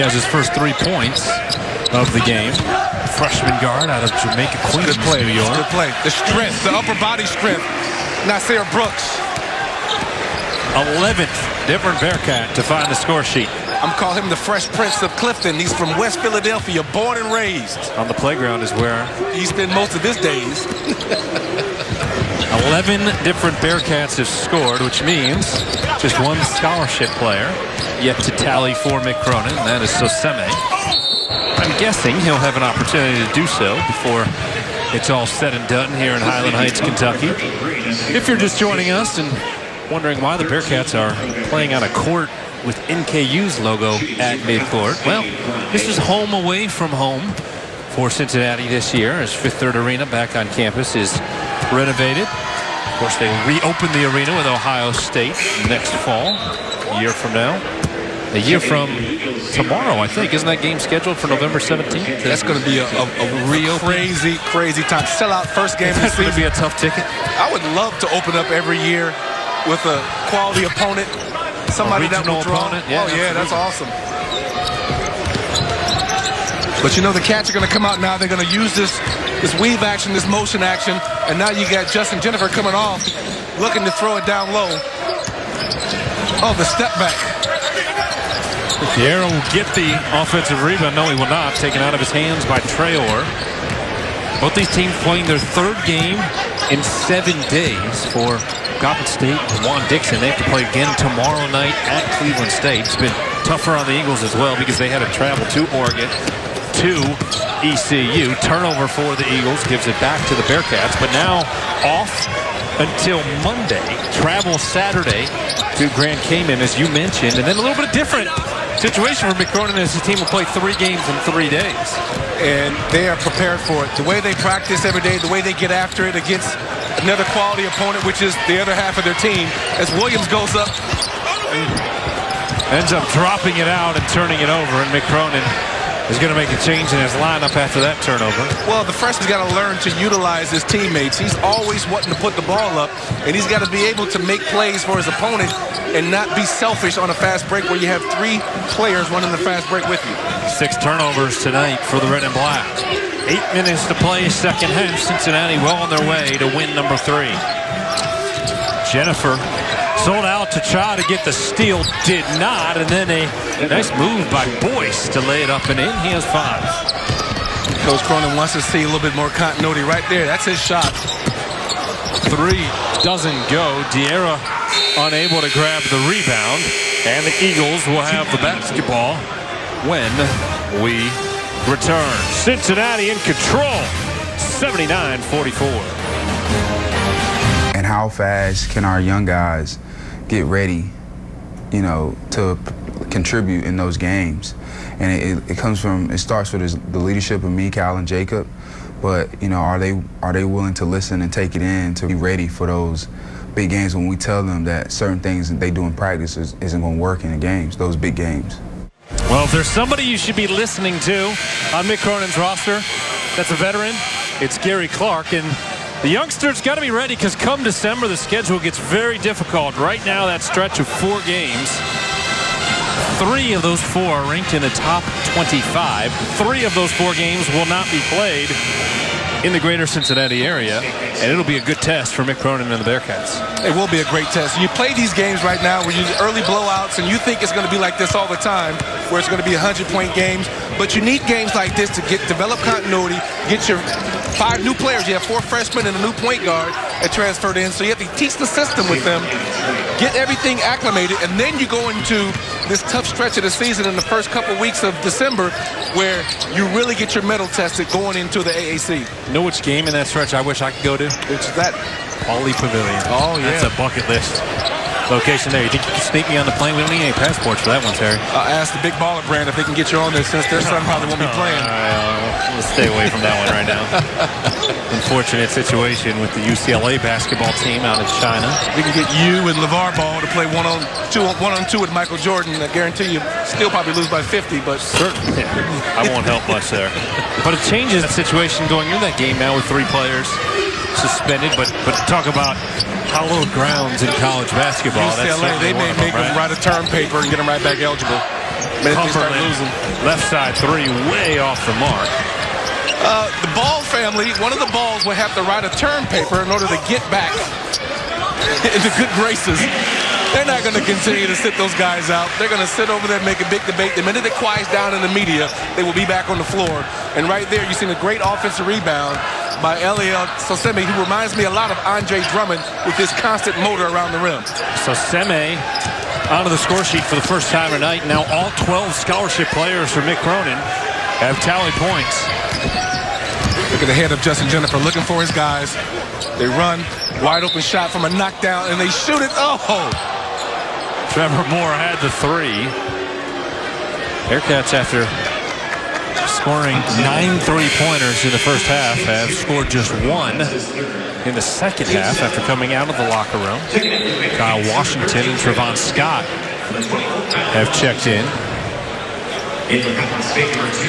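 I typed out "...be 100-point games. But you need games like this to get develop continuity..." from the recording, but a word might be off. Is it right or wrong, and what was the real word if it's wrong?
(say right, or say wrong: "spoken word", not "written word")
right.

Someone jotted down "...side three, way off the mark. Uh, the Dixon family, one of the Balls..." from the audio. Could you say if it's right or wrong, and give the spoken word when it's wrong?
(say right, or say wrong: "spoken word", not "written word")
wrong: "Ball", not "Dixon".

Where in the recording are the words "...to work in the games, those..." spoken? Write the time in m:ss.
3:26.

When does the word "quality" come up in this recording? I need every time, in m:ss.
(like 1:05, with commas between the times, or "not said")
1:10, 2:07.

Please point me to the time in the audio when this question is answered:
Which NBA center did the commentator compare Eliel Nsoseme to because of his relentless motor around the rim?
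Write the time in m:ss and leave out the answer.
5:21.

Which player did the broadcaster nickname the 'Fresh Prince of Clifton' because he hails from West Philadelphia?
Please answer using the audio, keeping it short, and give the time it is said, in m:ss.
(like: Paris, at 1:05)
Nysier Brooks, at 0:08.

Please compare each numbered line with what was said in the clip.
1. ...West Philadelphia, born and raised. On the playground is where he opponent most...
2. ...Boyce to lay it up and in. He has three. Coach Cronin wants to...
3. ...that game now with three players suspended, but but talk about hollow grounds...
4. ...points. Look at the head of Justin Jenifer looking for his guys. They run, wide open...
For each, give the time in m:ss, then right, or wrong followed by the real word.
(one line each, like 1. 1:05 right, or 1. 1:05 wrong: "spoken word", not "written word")
1. 0:15 wrong: "spent", not "opponent"
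2. 2:44 wrong: "five", not "three"
3. 4:49 right
4. 5:31 right.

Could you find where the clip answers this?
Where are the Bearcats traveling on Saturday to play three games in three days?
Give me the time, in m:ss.
1:55.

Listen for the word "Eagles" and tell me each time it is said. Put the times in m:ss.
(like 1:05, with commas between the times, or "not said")
1:43, 1:49, 2:57.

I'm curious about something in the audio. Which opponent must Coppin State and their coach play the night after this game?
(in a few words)
Cleveland State.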